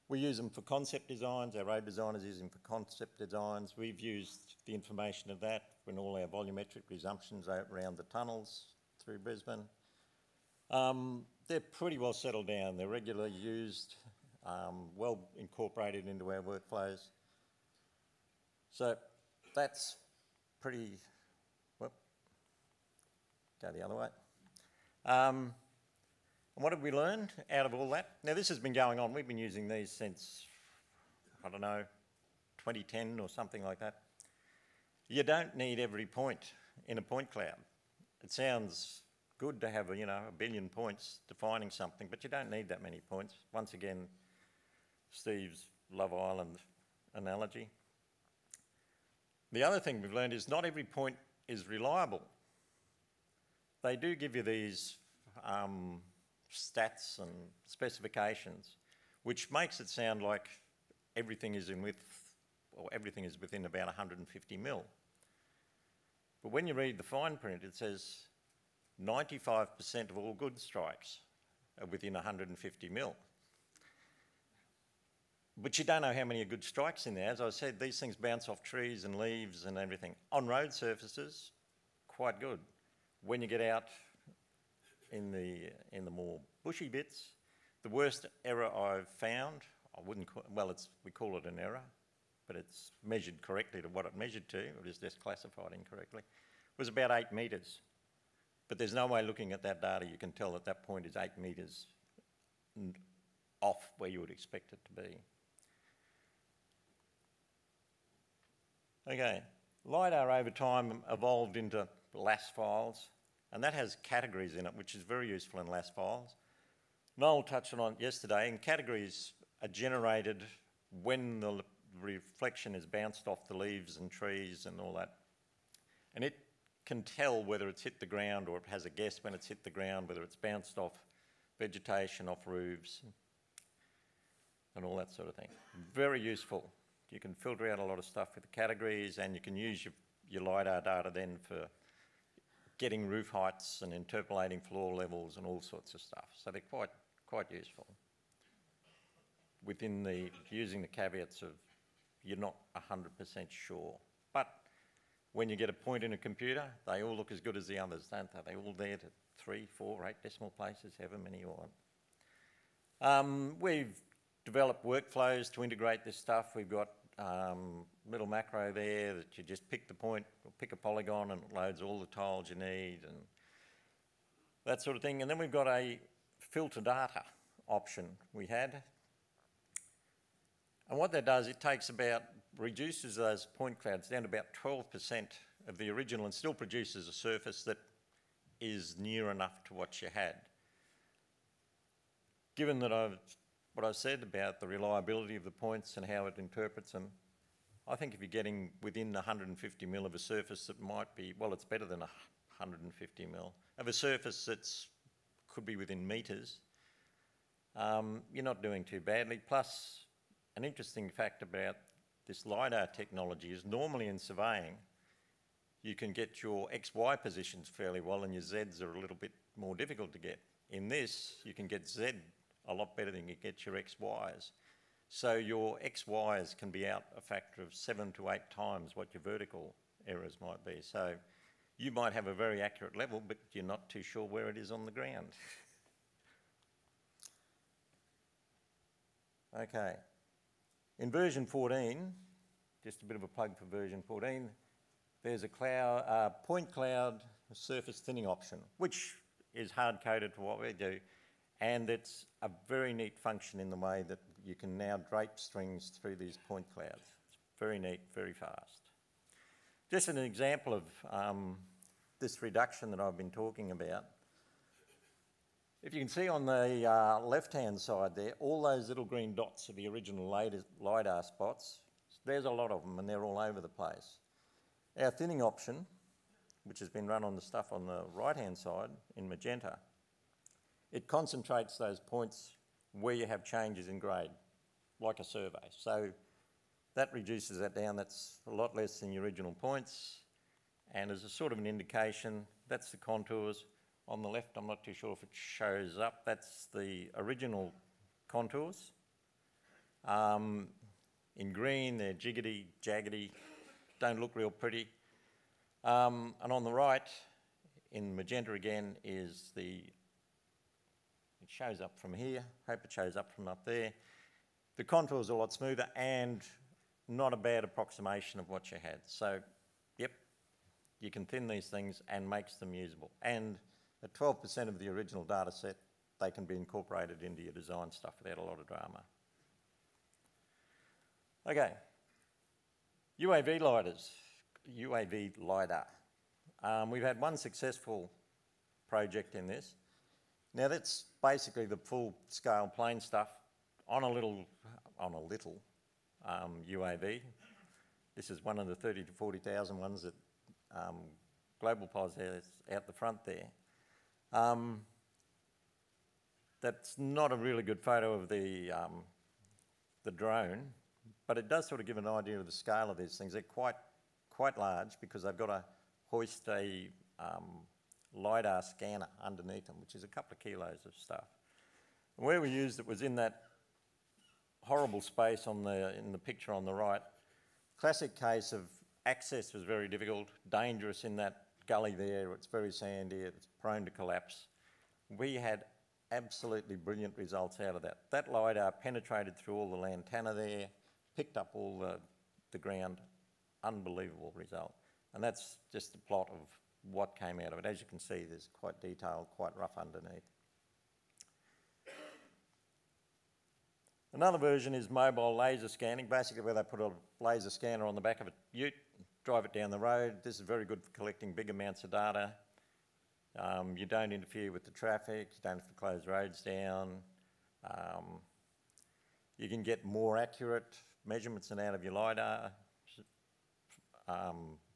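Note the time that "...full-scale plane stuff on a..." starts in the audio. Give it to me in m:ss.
5:41.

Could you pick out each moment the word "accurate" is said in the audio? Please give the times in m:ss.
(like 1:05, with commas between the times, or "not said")
3:52, 7:00.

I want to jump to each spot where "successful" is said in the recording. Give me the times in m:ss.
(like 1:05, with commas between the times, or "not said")
5:37.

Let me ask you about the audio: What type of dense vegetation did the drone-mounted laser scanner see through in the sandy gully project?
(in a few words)
Lantana.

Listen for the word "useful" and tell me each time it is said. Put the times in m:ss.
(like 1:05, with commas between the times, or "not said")
1:55, 2:16, 2:27.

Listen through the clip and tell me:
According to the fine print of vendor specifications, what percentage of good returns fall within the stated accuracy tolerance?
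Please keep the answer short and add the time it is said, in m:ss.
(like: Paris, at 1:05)
95%, at 1:09.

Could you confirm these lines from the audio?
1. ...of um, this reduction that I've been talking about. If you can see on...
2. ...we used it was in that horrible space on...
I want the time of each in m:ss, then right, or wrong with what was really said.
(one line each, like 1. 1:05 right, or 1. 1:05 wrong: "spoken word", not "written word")
1. 4:20 right
2. 6:12 right.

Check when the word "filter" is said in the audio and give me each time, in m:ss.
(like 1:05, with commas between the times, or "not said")
2:17, 2:56.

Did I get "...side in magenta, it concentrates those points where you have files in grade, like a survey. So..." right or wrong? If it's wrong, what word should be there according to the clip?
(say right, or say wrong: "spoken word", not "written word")
wrong: "changes", not "files".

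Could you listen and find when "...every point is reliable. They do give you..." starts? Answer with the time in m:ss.
0:50.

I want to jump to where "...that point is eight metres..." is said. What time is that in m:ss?
1:40.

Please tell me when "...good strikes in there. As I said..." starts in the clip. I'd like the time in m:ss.
1:16.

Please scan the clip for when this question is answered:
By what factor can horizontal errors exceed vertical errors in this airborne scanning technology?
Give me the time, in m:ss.
3:47.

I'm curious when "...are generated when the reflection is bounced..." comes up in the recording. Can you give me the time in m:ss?
1:59.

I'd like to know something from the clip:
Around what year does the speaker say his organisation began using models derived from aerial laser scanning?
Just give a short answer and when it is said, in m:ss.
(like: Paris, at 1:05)
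2010, at 0:32.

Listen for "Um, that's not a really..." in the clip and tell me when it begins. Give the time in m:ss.
5:54.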